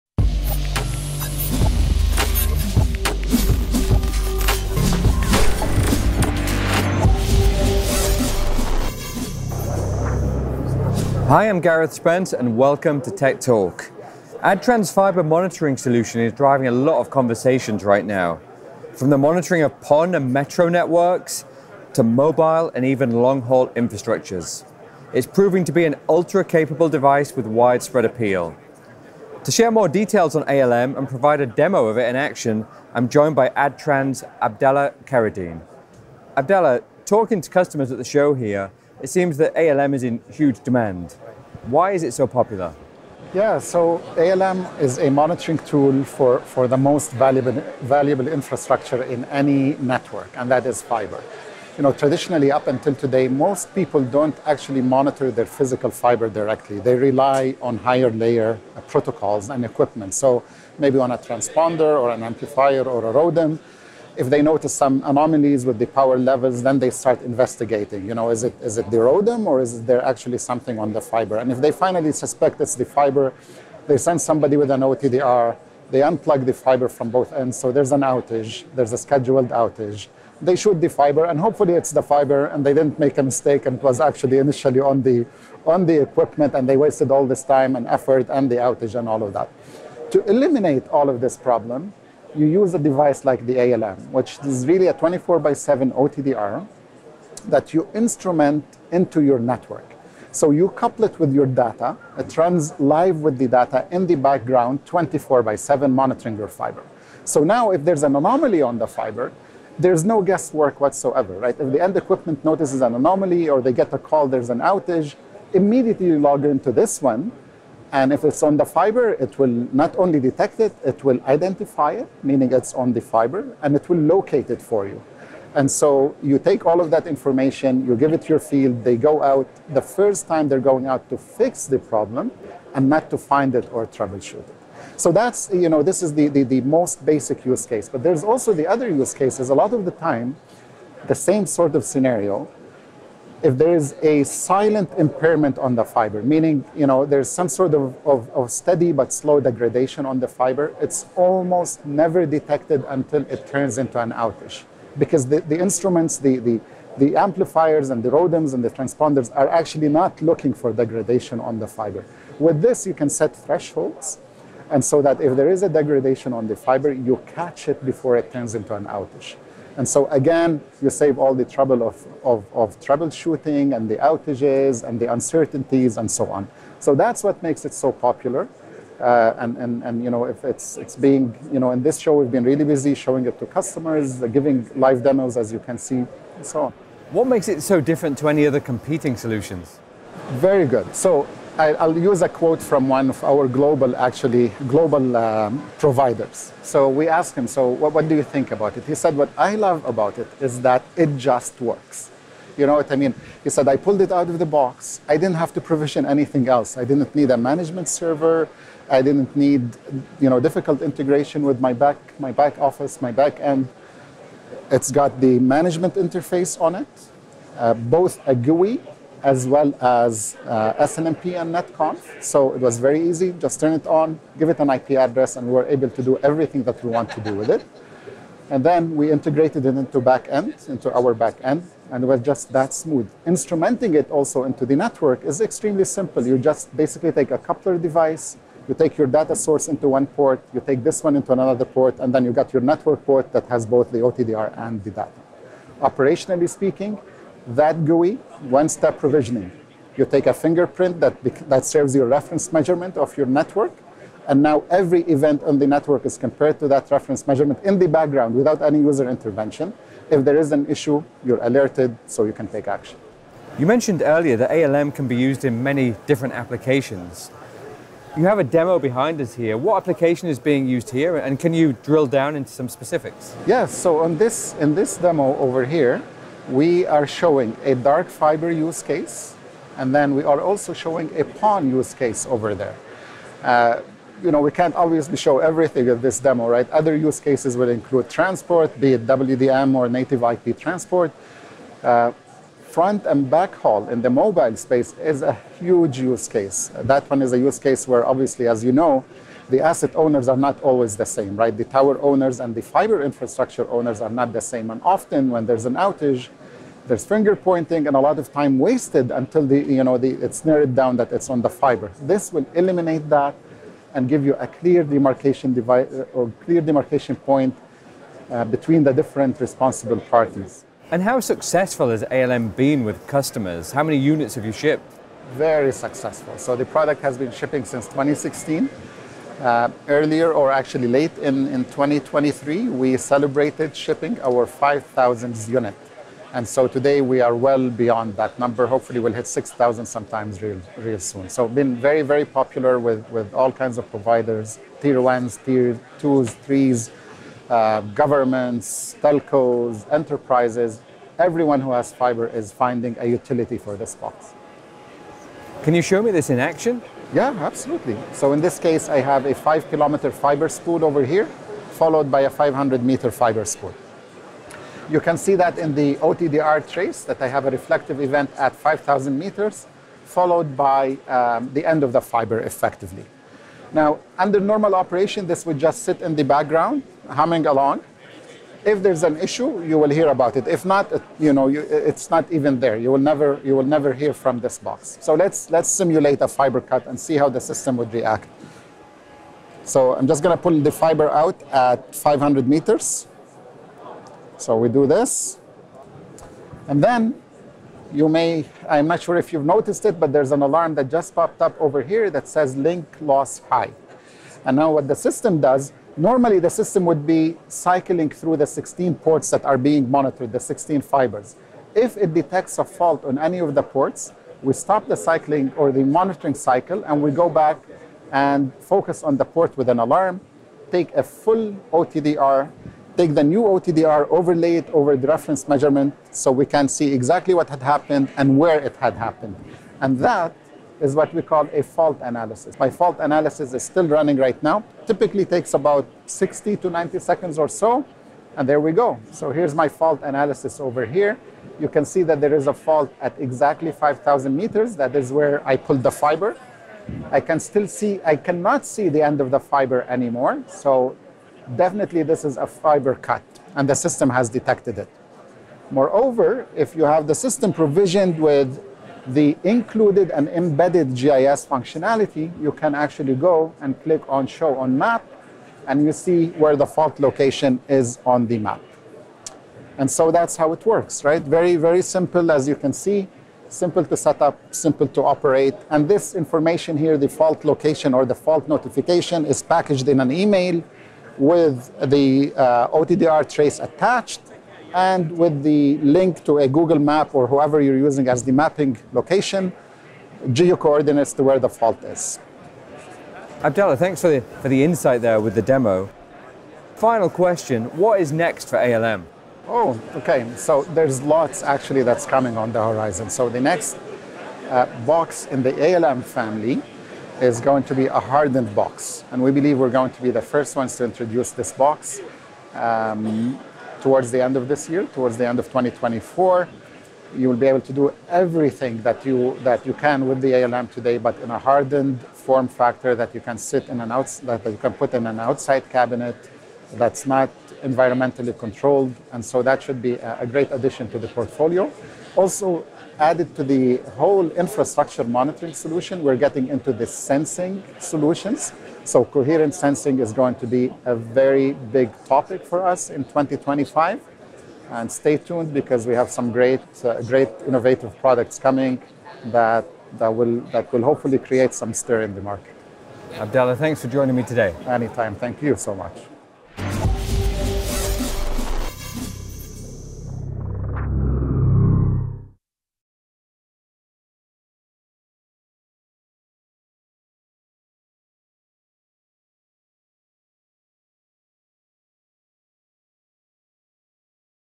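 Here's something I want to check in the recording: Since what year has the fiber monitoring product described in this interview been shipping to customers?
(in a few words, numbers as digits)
2016.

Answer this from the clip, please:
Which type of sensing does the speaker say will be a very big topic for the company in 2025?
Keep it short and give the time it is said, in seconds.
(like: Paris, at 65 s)
coherent sensing, at 539 s.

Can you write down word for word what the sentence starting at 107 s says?
So now if there's an anomaly on the fiber, there's no guesswork whatsoever, right?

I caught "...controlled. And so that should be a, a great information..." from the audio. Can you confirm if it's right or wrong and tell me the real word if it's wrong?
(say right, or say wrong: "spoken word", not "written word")
wrong: "addition", not "information".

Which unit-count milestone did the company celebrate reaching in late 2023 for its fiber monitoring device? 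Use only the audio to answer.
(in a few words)
5,000th unit.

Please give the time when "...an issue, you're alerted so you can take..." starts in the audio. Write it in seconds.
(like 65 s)
260 s.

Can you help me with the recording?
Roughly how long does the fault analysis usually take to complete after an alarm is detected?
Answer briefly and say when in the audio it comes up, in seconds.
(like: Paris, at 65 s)
60 to 90 seconds, at 436 s.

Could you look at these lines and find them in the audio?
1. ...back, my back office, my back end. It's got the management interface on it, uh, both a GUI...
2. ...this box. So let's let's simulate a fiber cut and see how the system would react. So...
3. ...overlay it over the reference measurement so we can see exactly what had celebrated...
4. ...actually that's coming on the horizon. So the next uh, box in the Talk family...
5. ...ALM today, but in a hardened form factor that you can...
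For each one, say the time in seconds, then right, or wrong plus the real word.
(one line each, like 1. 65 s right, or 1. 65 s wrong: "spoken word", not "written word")
1. 211 s right
2. 384 s right
3. 424 s wrong: "happened", not "celebrated"
4. 501 s wrong: "ALM", not "Talk"
5. 520 s right.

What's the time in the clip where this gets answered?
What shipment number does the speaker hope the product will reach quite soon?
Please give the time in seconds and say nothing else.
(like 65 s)
339 s.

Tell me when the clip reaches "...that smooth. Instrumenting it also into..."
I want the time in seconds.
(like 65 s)
232 s.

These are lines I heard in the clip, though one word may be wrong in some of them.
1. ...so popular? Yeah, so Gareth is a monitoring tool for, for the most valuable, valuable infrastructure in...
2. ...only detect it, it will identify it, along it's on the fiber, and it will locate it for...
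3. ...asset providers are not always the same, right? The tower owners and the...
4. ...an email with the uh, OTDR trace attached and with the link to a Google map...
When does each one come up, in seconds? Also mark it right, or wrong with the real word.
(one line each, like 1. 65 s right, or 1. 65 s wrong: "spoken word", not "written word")
1. 42 s wrong: "ALM", not "Gareth"
2. 119 s wrong: "meaning", not "along"
3. 299 s wrong: "owners", not "providers"
4. 479 s right.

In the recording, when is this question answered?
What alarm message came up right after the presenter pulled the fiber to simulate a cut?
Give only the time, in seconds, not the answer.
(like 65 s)
402 s.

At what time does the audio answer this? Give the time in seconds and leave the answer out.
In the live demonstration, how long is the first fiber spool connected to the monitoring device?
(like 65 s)
359 s.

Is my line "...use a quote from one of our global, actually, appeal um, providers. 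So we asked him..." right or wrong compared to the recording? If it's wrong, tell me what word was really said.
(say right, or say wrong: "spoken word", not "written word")
wrong: "global", not "appeal".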